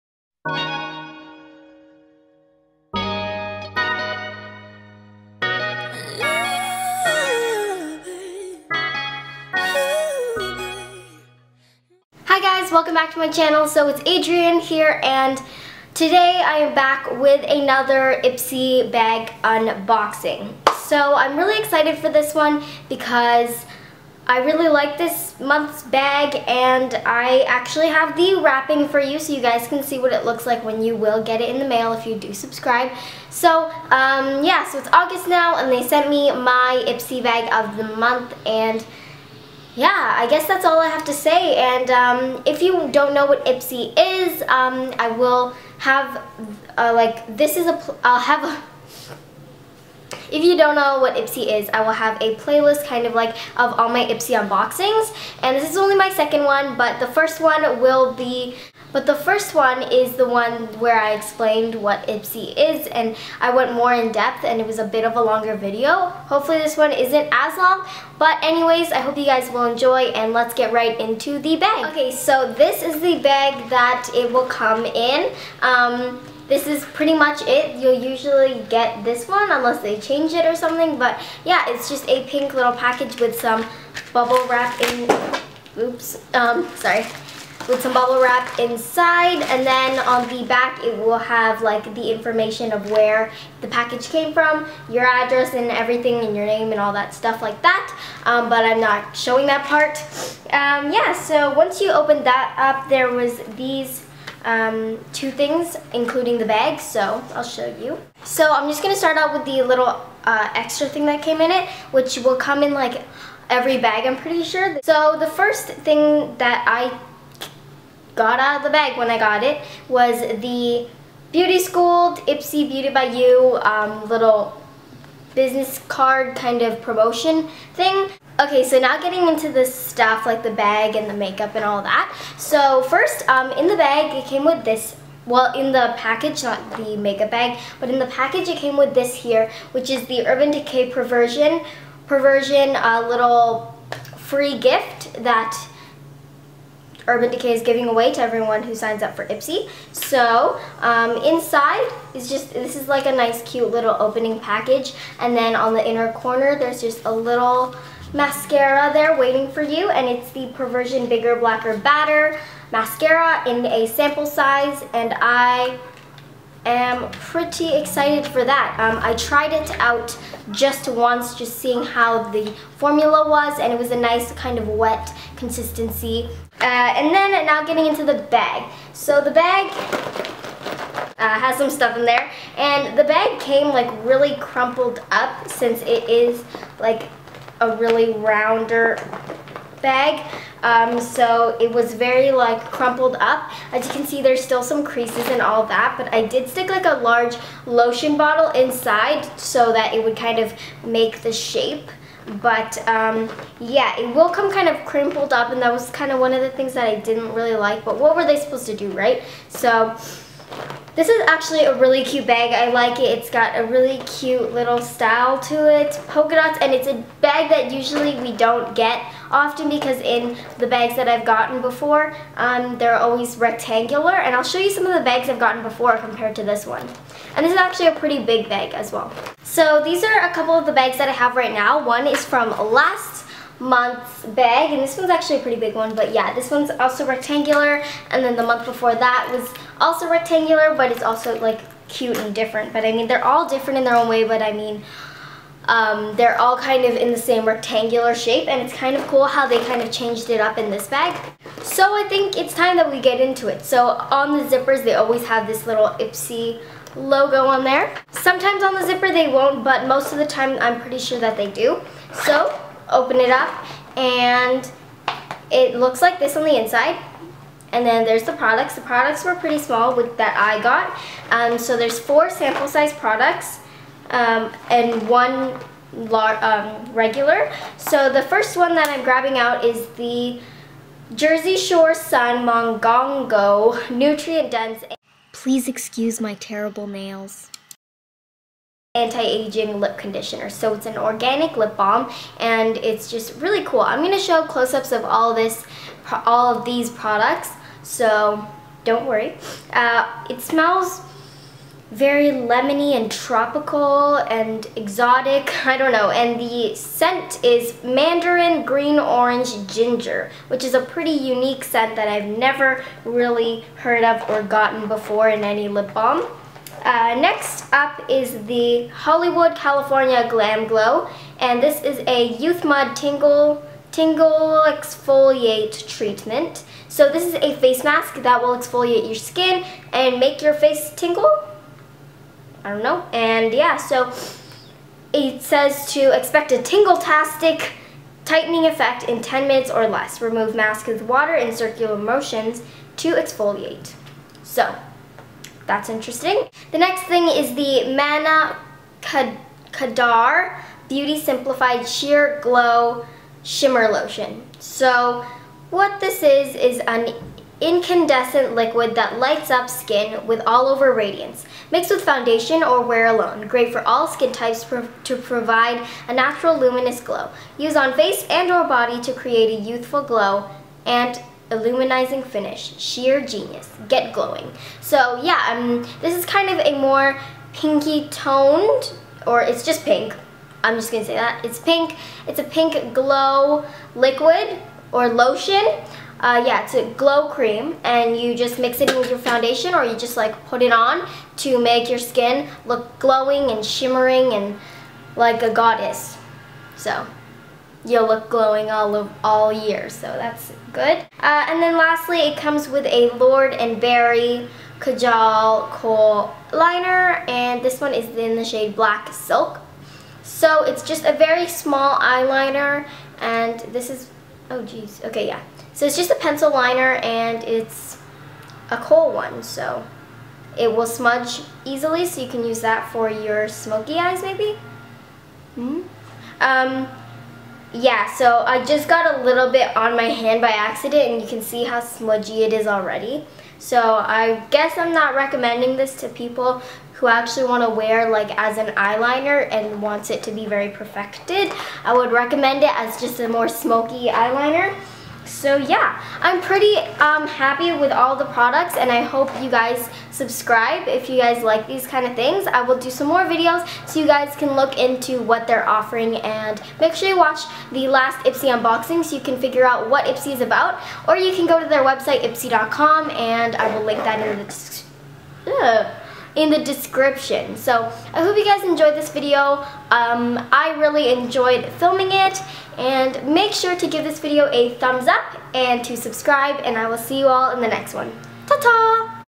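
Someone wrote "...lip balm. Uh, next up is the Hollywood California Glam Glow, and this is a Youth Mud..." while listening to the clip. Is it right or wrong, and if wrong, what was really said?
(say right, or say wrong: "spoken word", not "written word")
right.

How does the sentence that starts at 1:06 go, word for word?
Hopefully this one isn't as long, but anyways, I hope you guys will enjoy and let's get right into the bag.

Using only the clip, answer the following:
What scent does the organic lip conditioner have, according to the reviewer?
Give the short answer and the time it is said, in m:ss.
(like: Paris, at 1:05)
Mandarin green orange ginger, at 5:07.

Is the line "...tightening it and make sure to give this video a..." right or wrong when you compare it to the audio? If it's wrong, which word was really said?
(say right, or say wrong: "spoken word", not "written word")
wrong: "filming", not "tightening".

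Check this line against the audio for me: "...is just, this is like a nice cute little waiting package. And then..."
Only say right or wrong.
wrong.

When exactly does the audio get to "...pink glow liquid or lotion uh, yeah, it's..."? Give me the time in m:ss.
6:22.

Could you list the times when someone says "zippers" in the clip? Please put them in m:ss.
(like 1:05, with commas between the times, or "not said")
4:14, 4:18.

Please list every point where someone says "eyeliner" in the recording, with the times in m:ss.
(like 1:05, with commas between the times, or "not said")
6:51, 7:18, 7:24.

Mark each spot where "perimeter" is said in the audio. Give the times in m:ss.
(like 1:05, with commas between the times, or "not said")
not said.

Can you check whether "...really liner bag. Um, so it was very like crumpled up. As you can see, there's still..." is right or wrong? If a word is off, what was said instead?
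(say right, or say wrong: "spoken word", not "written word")
wrong: "rounder", not "liner".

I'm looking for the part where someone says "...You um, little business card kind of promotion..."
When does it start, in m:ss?
2:03.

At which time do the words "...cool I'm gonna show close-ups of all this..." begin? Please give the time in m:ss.
4:53.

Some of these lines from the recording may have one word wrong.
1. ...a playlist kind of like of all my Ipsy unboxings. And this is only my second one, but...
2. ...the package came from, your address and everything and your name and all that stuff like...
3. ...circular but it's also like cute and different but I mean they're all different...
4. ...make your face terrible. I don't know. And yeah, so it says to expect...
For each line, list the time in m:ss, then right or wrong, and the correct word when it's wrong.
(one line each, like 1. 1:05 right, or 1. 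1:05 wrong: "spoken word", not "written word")
1. 0:52 right
2. 1:33 right
3. 4:00 wrong: "rectangular", not "circular"
4. 5:30 wrong: "tingle", not "terrible".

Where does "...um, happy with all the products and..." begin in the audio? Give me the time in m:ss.
7:26.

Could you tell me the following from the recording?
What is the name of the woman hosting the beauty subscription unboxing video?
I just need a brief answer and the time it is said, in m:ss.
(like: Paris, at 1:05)
Adrienne, at 0:14.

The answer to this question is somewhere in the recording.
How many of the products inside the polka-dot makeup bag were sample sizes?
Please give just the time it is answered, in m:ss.
4:31.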